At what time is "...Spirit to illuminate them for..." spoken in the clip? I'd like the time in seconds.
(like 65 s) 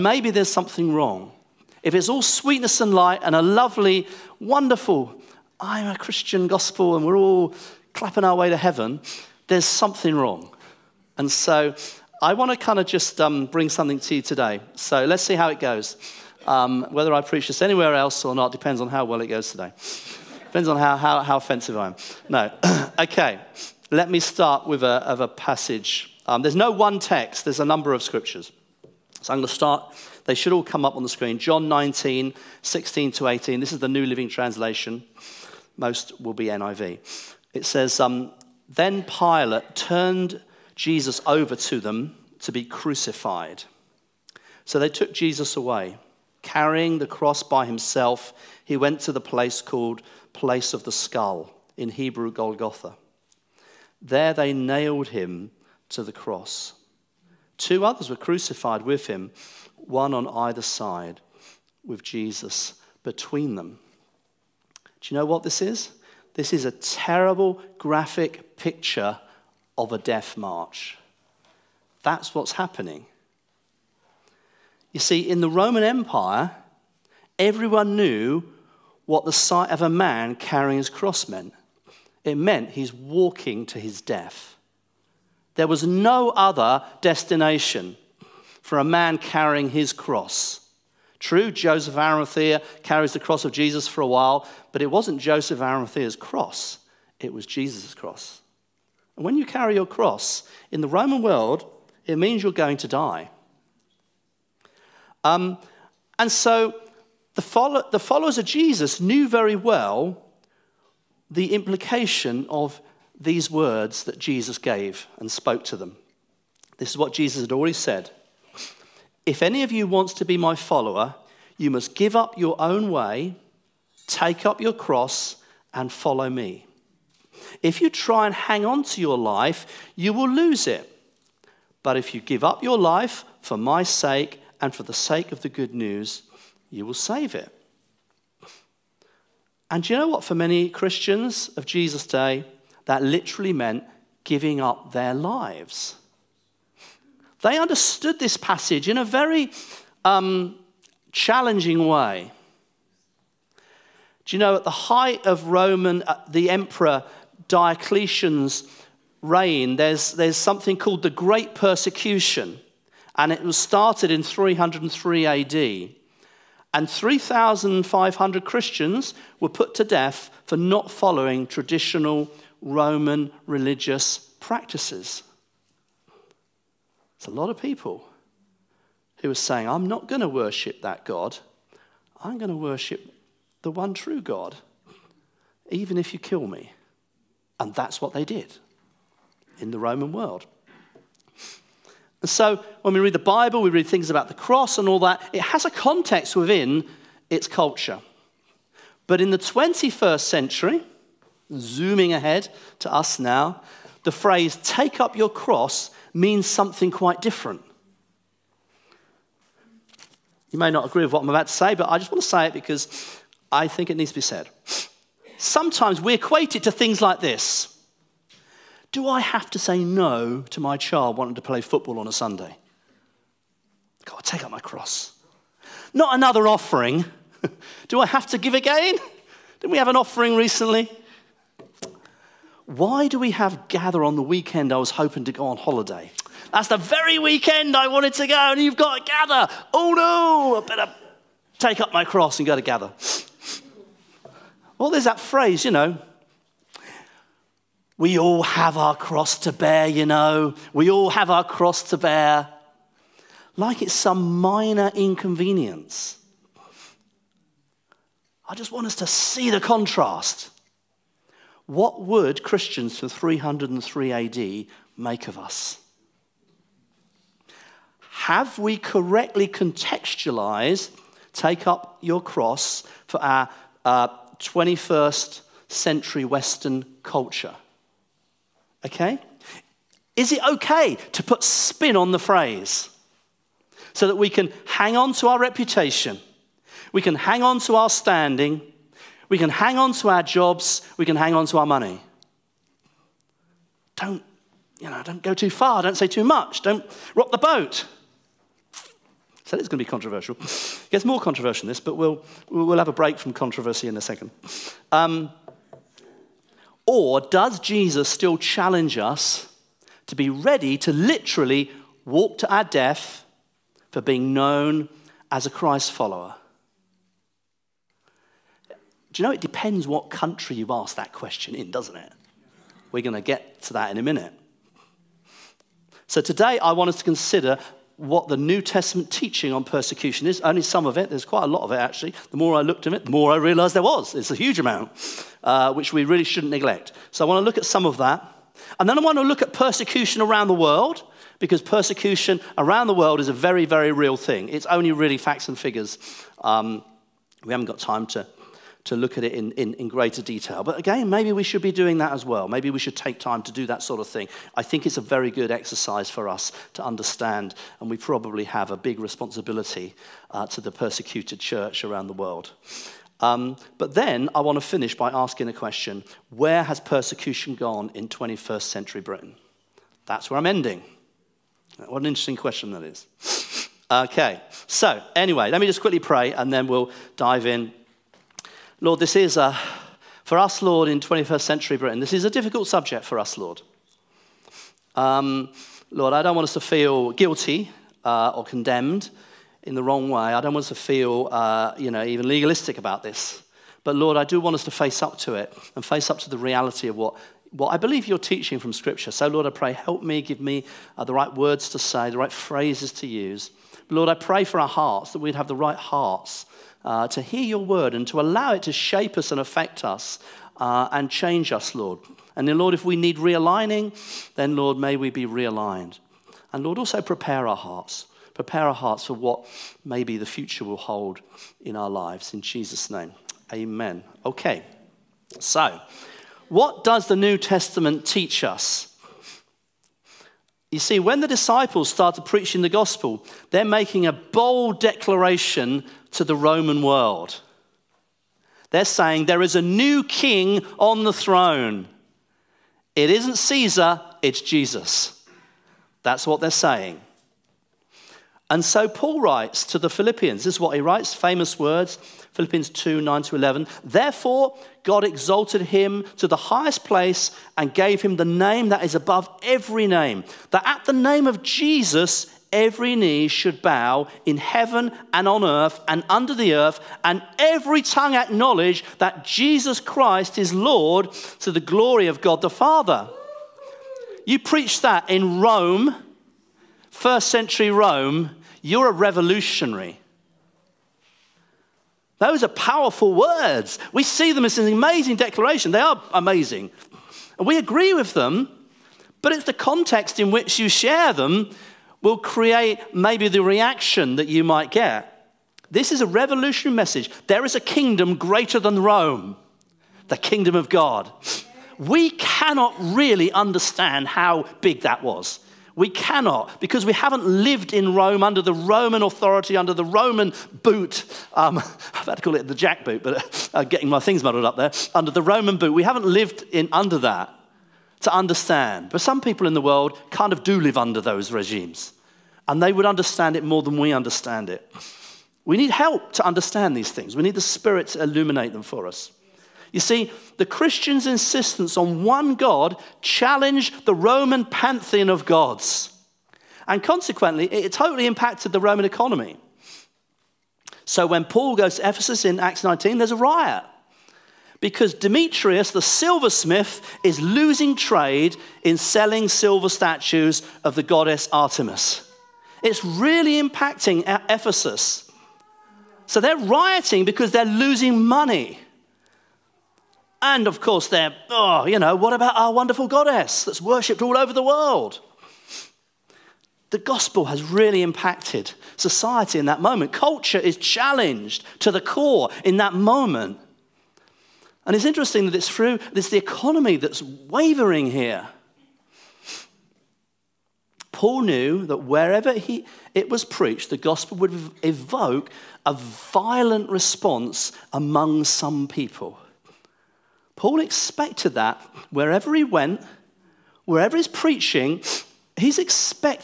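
527 s.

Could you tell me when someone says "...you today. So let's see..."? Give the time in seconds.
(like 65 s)
14 s.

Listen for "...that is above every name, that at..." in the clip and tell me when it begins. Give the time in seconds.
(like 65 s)
458 s.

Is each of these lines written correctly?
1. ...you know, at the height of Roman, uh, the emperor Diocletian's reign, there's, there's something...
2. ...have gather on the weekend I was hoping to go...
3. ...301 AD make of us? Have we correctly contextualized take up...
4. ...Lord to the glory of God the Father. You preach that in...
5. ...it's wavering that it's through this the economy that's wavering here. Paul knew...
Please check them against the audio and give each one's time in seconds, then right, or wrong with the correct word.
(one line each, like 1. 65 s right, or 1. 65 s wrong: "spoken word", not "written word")
1. 154 s right
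2. 233 s right
3. 263 s wrong: "303", not "301"
4. 470 s right
5. 574 s wrong: "interesting", not "wavering".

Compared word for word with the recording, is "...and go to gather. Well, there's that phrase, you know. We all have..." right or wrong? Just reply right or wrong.
right.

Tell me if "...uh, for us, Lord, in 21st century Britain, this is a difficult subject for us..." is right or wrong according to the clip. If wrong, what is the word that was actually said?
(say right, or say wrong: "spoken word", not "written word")
right.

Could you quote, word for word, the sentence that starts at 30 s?
They should all come up on the screen.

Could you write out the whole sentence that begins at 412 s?
And then, Lord, if we need realigning, then, Lord, may we be realigned.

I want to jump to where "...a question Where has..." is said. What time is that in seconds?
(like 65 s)
365 s.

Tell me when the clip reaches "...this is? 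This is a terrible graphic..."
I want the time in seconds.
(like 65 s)
65 s.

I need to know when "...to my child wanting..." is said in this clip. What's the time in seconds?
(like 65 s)
220 s.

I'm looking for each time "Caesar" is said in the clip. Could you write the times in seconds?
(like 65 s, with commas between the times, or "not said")
443 s.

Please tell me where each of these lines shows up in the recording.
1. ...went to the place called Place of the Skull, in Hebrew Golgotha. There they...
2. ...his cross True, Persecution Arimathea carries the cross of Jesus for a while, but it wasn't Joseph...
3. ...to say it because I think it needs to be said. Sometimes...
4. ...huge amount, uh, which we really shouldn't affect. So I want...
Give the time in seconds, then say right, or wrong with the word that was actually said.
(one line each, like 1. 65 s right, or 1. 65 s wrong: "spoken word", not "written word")
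1. 48 s right
2. 89 s wrong: "Joseph", not "Persecution"
3. 212 s right
4. 334 s wrong: "neglect", not "affect".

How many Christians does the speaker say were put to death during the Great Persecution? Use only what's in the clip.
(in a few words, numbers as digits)
3,500.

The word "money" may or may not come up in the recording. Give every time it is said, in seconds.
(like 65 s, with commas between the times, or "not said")
291 s, 558 s.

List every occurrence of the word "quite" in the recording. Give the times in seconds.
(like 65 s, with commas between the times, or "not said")
206 s, 331 s.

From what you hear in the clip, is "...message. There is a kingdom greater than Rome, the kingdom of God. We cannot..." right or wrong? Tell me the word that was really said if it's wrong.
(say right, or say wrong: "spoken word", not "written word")
right.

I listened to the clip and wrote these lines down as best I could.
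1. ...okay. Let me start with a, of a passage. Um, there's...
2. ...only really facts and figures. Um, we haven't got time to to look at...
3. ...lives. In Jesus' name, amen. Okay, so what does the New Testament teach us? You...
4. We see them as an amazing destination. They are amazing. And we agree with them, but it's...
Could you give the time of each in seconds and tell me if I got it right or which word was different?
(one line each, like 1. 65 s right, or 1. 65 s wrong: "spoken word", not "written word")
1. 22 s right
2. 344 s right
3. 421 s right
4. 483 s wrong: "declaration", not "destination".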